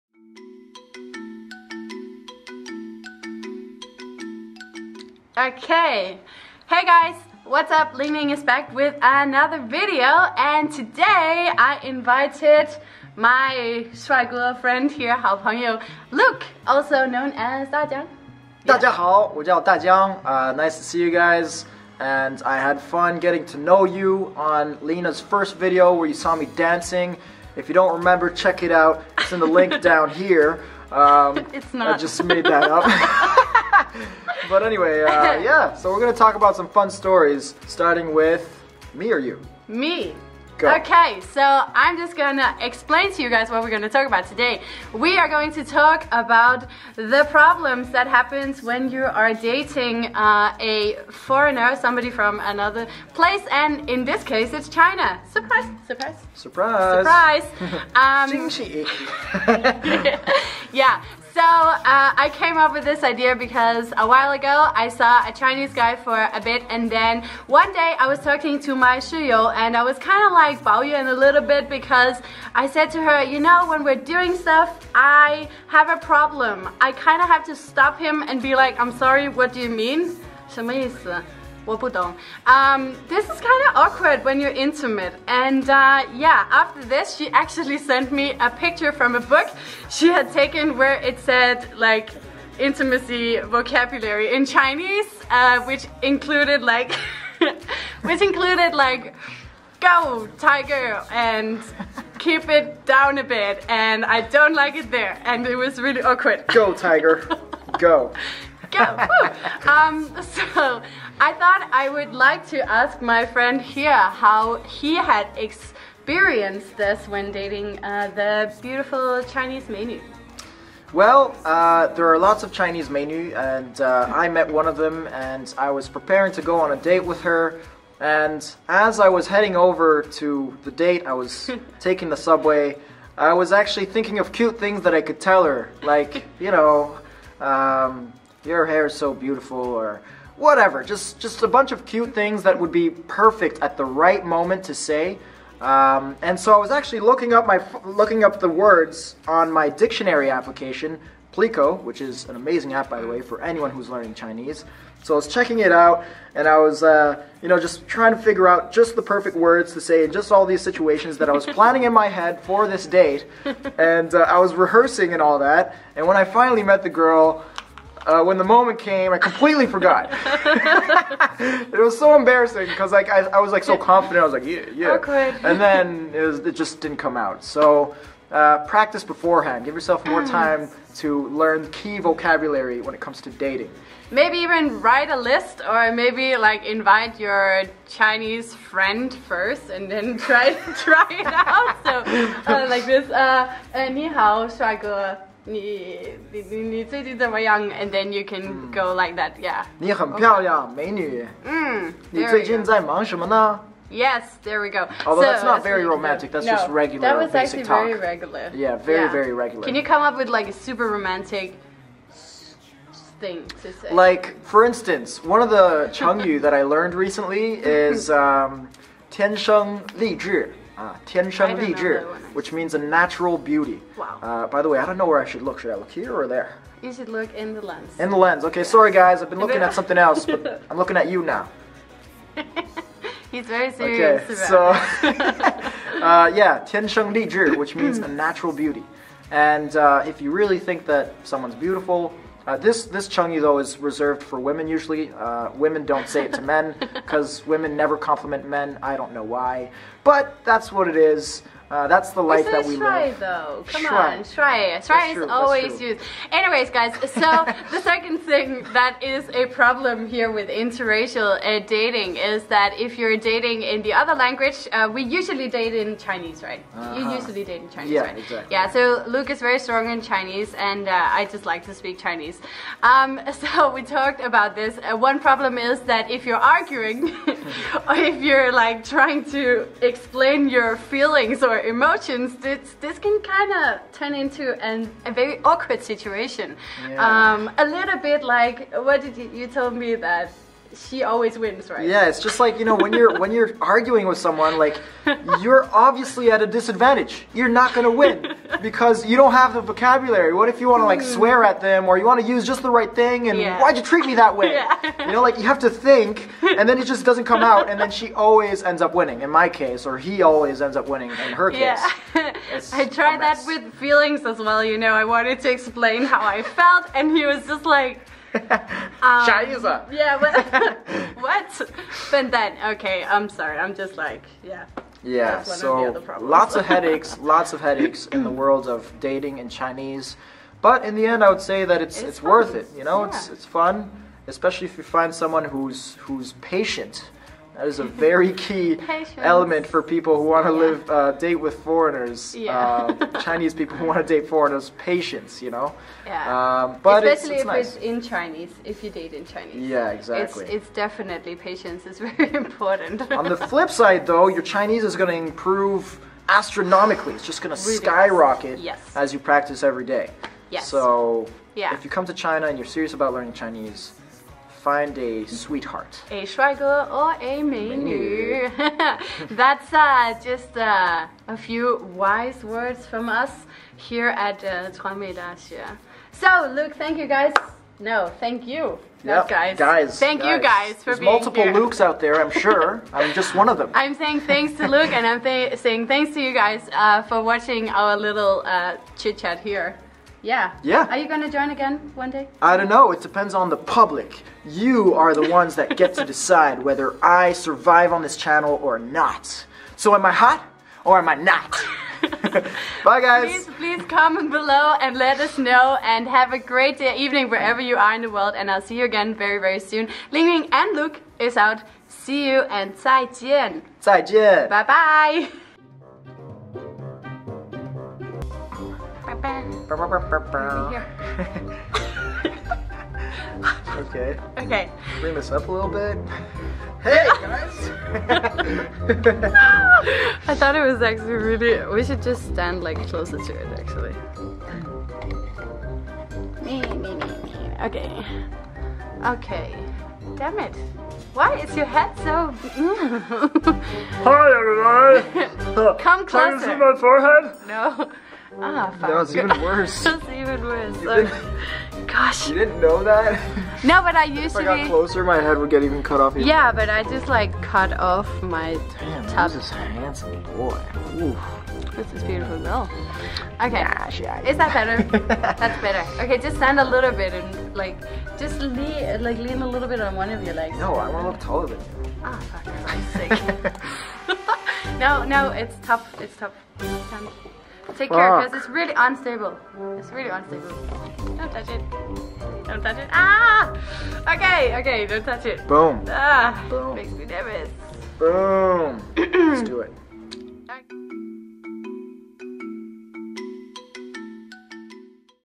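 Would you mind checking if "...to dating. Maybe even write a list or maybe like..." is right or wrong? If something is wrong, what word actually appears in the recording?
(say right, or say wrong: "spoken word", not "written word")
right.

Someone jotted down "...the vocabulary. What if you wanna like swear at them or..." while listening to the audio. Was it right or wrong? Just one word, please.
right.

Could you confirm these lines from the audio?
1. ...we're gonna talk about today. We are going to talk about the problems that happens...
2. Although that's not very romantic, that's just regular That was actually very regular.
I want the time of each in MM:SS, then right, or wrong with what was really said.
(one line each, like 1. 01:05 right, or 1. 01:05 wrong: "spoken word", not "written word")
1. 00:43 right
2. 03:25 right.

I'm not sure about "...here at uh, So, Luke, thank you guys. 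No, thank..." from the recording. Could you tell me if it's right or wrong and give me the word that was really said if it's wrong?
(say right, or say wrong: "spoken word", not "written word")
right.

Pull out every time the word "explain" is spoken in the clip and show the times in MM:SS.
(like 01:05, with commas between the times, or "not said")
00:42, 04:39, 05:15.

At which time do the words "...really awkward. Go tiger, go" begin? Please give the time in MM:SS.
01:45.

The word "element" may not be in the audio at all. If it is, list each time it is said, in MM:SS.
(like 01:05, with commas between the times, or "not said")
05:39.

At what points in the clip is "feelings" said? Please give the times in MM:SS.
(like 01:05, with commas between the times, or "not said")
04:40, 05:13.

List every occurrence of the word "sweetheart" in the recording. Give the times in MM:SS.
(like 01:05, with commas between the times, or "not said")
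06:05.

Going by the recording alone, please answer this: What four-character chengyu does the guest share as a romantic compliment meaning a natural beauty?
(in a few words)
Tiansheng Lizhi.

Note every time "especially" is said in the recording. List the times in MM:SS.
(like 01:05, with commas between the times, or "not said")
05:34, 05:47.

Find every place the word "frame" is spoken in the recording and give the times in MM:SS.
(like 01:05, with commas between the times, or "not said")
not said.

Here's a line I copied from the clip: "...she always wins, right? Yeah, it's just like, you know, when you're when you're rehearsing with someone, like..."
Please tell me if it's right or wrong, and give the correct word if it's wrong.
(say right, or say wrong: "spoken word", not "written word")
wrong: "arguing", not "rehearsing".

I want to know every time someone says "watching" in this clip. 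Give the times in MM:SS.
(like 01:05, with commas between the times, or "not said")
06:27.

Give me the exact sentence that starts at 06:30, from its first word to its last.
Are you going to join again one day?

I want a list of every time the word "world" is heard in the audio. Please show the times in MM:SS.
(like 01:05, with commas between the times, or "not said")
05:28, 06:48.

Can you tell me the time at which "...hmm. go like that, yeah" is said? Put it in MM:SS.
03:18.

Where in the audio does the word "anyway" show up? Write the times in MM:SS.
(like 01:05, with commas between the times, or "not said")
00:34, 04:16.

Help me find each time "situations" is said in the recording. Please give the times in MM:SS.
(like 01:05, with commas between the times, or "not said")
02:40, 04:45.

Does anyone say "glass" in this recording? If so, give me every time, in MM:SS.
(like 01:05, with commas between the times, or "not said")
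not said.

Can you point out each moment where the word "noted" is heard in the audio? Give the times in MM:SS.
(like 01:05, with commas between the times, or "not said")
not said.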